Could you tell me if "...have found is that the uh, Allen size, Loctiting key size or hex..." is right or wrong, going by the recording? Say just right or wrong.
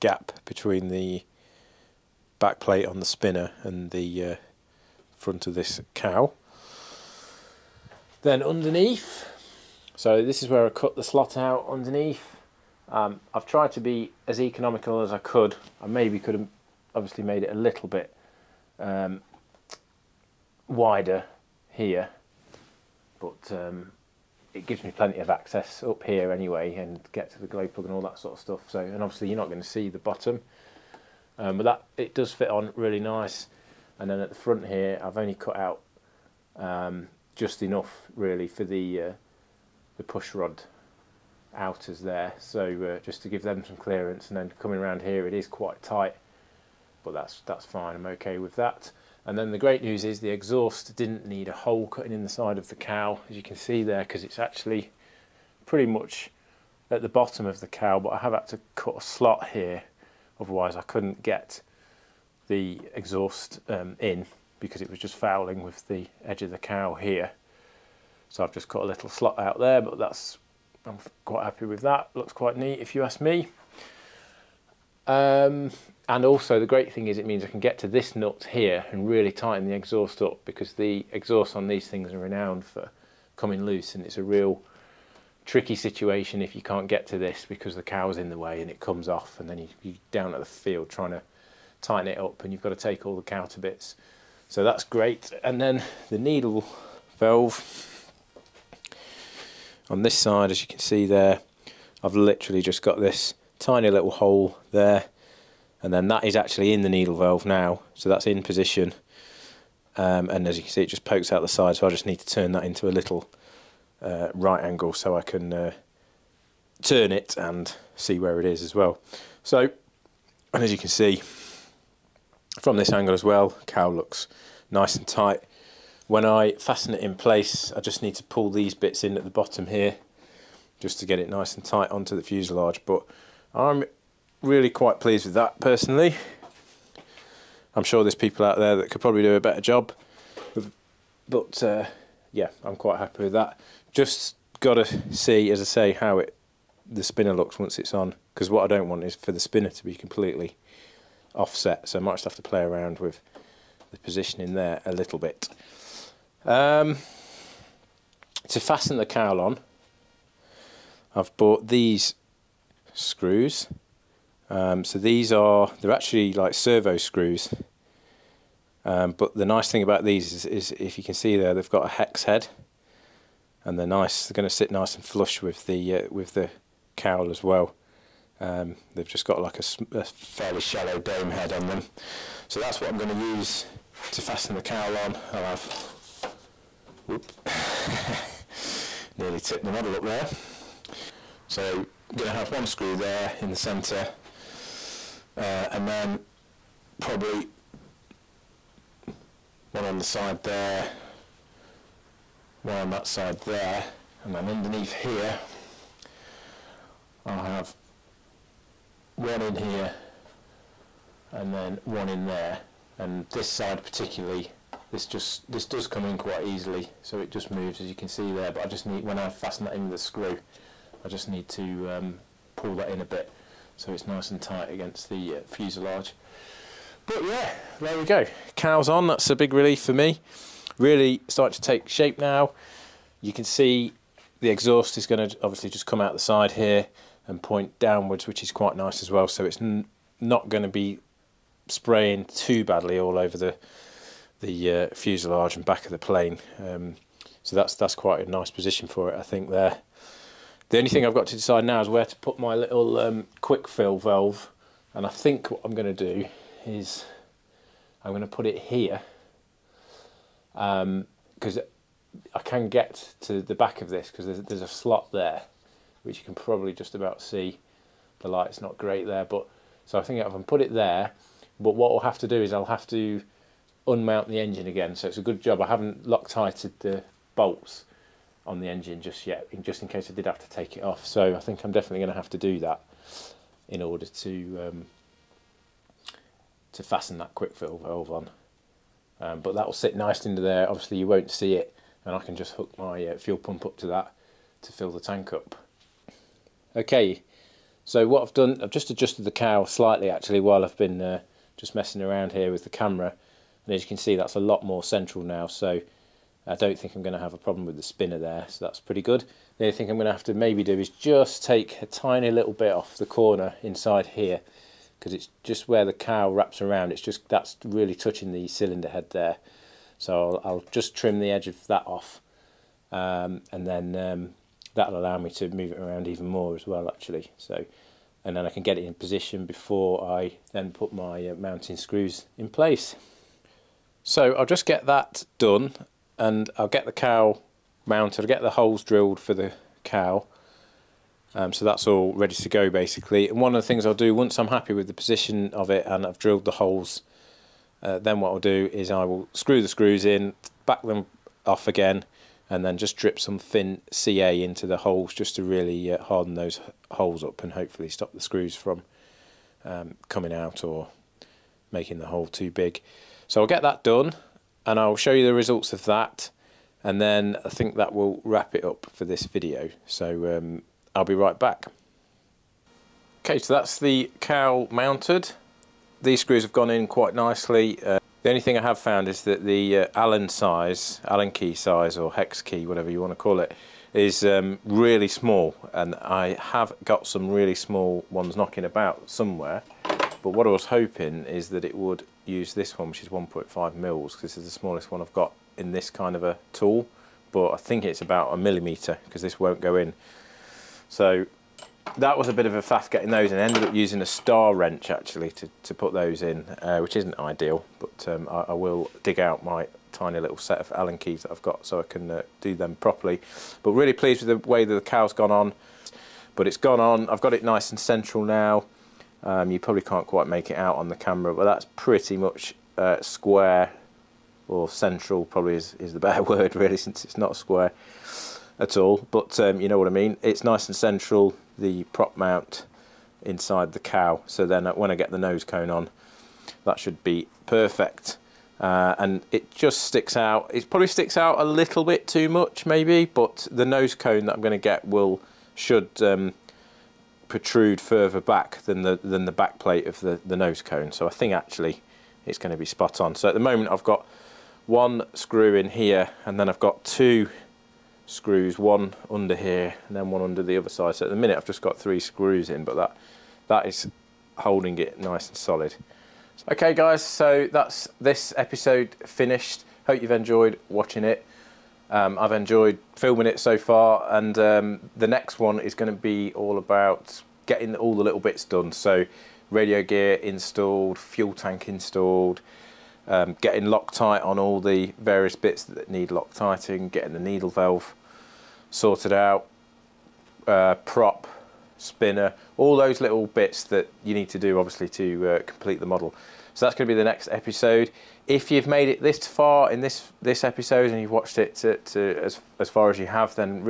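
wrong.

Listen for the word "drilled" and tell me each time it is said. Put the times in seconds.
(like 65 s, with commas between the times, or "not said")
338 s, 346 s.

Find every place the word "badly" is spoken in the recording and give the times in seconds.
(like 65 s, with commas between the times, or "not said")
242 s.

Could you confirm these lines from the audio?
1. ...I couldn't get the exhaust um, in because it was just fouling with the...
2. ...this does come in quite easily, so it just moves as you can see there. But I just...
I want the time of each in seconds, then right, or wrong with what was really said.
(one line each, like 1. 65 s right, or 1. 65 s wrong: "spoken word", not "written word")
1. 60 s right
2. 215 s right.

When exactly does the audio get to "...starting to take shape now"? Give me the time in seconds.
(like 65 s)
231 s.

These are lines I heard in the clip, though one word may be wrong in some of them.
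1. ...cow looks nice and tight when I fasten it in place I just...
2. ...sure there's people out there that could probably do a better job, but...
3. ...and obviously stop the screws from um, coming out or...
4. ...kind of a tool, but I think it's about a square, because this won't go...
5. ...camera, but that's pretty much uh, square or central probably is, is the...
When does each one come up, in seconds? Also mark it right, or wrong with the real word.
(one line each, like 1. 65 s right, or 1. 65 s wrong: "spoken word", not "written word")
1. 123 s right
2. 137 s right
3. 357 s wrong: "hopefully", not "obviously"
4. 395 s wrong: "millimetre", not "square"
5. 420 s right.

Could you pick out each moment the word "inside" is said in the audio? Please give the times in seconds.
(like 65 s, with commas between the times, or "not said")
313 s, 433 s.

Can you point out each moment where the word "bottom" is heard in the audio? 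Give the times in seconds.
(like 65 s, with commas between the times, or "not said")
29 s, 57 s, 129 s.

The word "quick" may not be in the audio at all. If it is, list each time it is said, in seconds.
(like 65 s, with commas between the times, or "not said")
253 s, 287 s.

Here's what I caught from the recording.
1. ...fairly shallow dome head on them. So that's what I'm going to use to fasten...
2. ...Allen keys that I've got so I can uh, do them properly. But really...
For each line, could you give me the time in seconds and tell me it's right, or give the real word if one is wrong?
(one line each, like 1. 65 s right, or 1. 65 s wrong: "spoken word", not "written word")
1. 180 s right
2. 410 s right.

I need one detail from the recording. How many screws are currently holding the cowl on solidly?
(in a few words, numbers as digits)
3.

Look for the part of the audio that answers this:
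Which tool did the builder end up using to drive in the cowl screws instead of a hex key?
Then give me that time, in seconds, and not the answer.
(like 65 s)
404 s.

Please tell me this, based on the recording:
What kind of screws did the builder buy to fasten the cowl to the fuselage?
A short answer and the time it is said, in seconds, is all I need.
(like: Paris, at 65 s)
Servo screws, at 166 s.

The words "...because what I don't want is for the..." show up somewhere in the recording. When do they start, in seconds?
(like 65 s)
148 s.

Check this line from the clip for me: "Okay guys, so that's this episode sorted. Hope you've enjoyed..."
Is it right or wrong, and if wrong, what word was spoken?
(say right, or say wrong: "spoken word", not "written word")
wrong: "finished", not "sorted".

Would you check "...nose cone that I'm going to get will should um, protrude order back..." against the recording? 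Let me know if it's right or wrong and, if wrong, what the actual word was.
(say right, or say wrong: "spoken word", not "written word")
wrong: "further", not "order".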